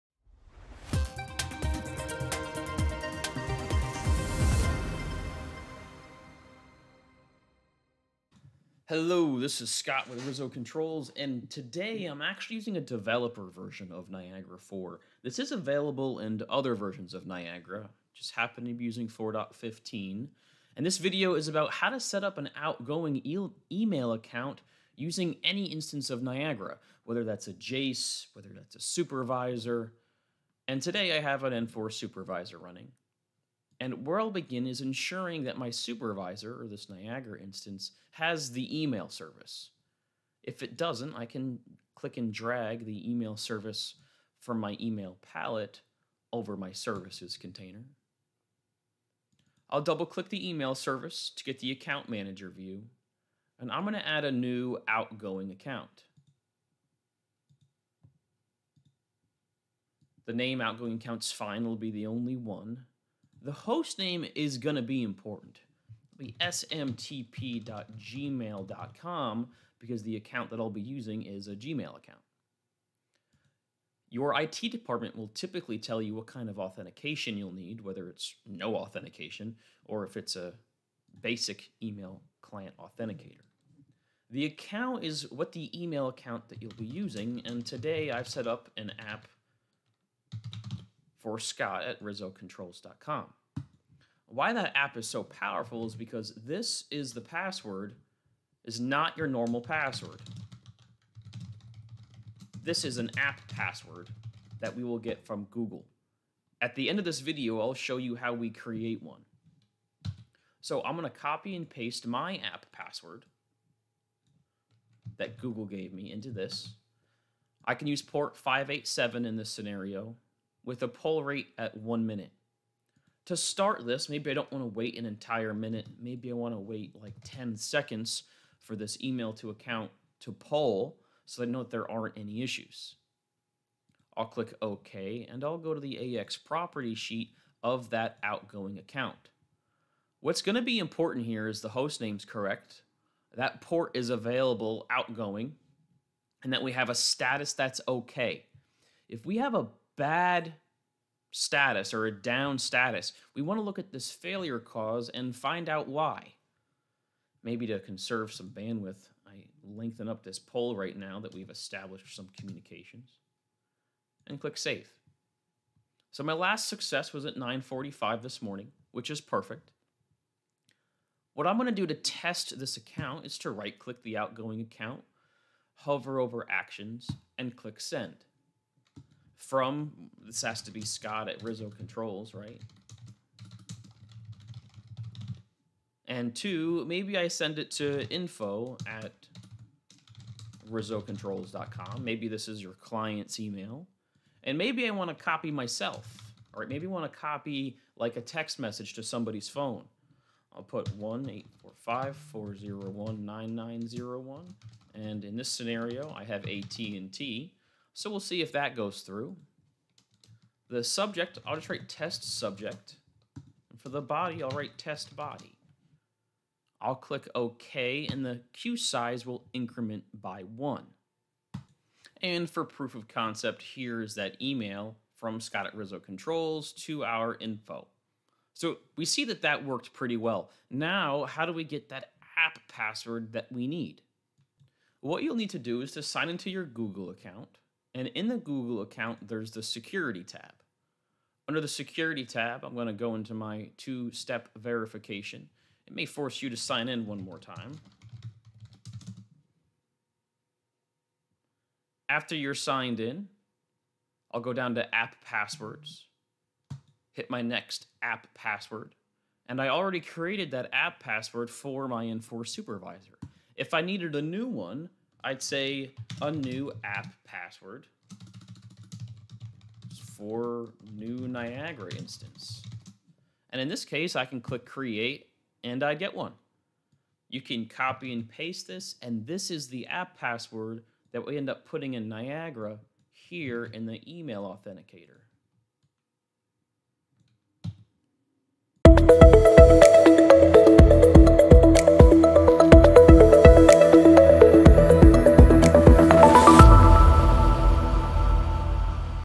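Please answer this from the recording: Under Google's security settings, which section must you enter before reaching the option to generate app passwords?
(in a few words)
two-step verification.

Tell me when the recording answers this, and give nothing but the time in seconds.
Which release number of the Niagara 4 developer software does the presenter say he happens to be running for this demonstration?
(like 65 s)
19 s.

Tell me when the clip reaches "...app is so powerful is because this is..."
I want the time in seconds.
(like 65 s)
94 s.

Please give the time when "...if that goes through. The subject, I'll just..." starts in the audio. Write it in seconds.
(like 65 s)
208 s.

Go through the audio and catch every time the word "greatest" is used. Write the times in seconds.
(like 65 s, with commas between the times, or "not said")
not said.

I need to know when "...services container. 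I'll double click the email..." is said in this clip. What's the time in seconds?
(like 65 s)
46 s.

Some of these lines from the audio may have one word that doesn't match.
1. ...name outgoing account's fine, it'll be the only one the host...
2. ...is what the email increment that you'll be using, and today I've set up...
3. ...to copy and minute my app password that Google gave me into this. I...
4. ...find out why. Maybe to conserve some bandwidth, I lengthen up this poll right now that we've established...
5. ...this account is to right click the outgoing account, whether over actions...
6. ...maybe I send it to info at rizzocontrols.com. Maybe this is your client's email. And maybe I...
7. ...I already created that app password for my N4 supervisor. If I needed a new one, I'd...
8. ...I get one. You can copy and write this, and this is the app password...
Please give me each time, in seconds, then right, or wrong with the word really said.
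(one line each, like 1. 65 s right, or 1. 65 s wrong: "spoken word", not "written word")
1. 60 s right
2. 85 s wrong: "account", not "increment"
3. 111 s wrong: "paste", not "minute"
4. 155 s right
5. 172 s wrong: "hover", not "whether"
6. 186 s right
7. 259 s right
8. 275 s wrong: "paste", not "write".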